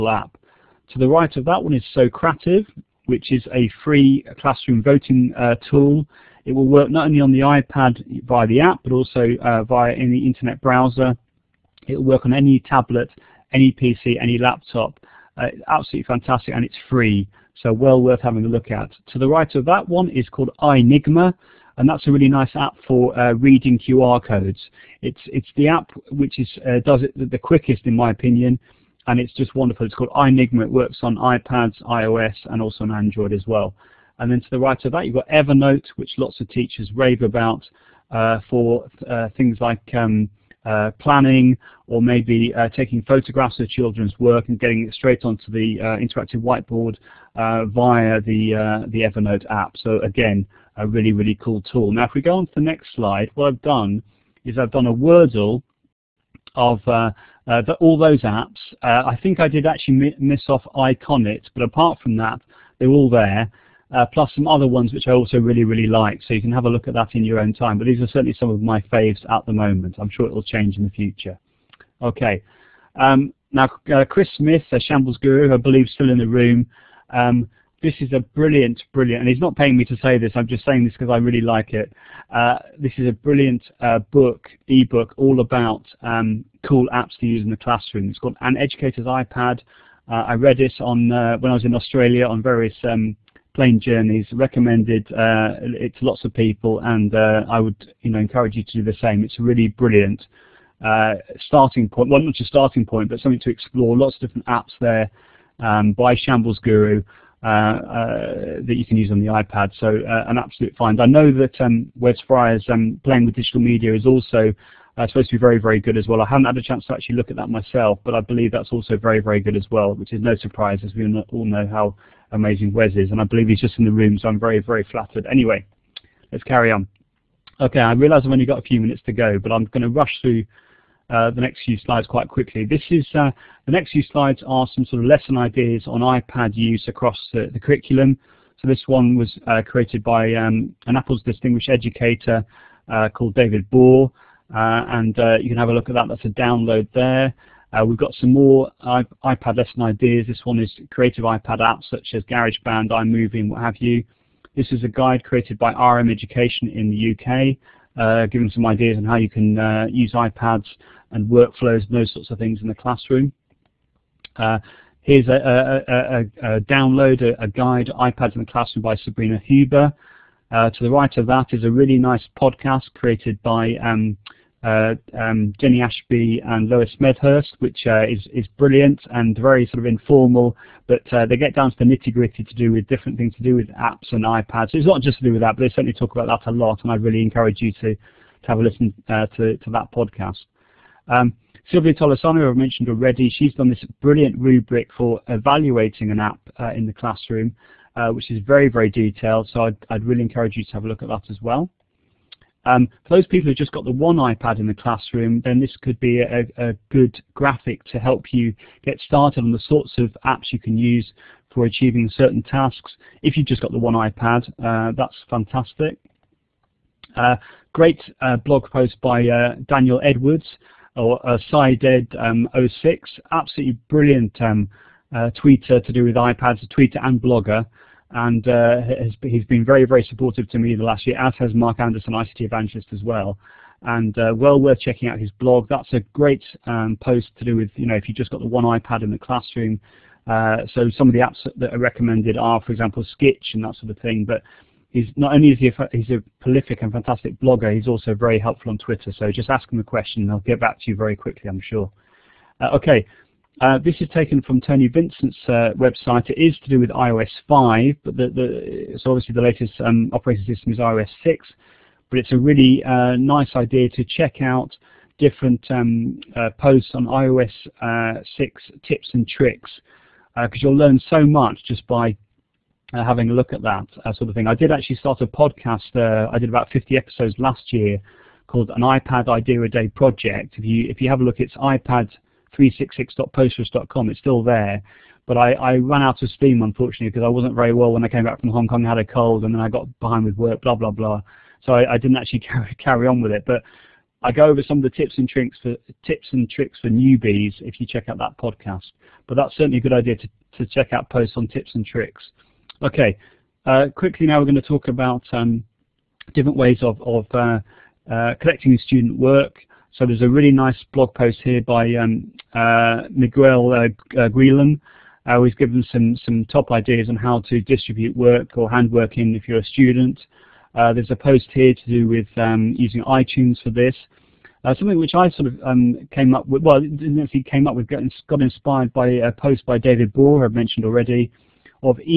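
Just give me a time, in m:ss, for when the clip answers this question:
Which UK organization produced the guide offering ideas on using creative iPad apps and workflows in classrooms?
2:35.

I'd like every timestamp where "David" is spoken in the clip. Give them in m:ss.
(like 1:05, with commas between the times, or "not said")
2:23, 5:29.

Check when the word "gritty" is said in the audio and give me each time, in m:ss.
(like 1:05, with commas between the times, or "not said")
3:02.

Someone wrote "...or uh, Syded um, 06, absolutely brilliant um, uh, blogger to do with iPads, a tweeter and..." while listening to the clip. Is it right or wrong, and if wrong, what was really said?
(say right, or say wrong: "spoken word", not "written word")
wrong: "tweeter", not "blogger".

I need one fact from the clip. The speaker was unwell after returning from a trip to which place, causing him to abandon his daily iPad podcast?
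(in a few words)
Hong Kong.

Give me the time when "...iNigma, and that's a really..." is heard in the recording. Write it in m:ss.
0:20.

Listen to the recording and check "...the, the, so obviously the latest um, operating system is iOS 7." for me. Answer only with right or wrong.
wrong.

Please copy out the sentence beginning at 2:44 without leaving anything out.
Uh, here's a, a, a, a download, a, guide, iPads in the Classroom by Sabrina Huber.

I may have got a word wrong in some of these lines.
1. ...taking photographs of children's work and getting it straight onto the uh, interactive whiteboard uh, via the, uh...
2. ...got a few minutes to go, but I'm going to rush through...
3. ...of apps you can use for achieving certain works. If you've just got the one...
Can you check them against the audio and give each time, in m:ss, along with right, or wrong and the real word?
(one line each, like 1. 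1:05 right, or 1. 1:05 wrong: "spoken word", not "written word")
1. 0:42 right
2. 2:08 right
3. 3:29 wrong: "tasks", not "works".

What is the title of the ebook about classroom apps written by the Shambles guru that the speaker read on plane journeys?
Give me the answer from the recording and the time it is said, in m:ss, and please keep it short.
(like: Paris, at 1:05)
An Educator's iPad, at 1:28.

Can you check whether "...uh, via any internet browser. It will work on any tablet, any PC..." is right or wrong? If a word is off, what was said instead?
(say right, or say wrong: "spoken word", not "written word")
right.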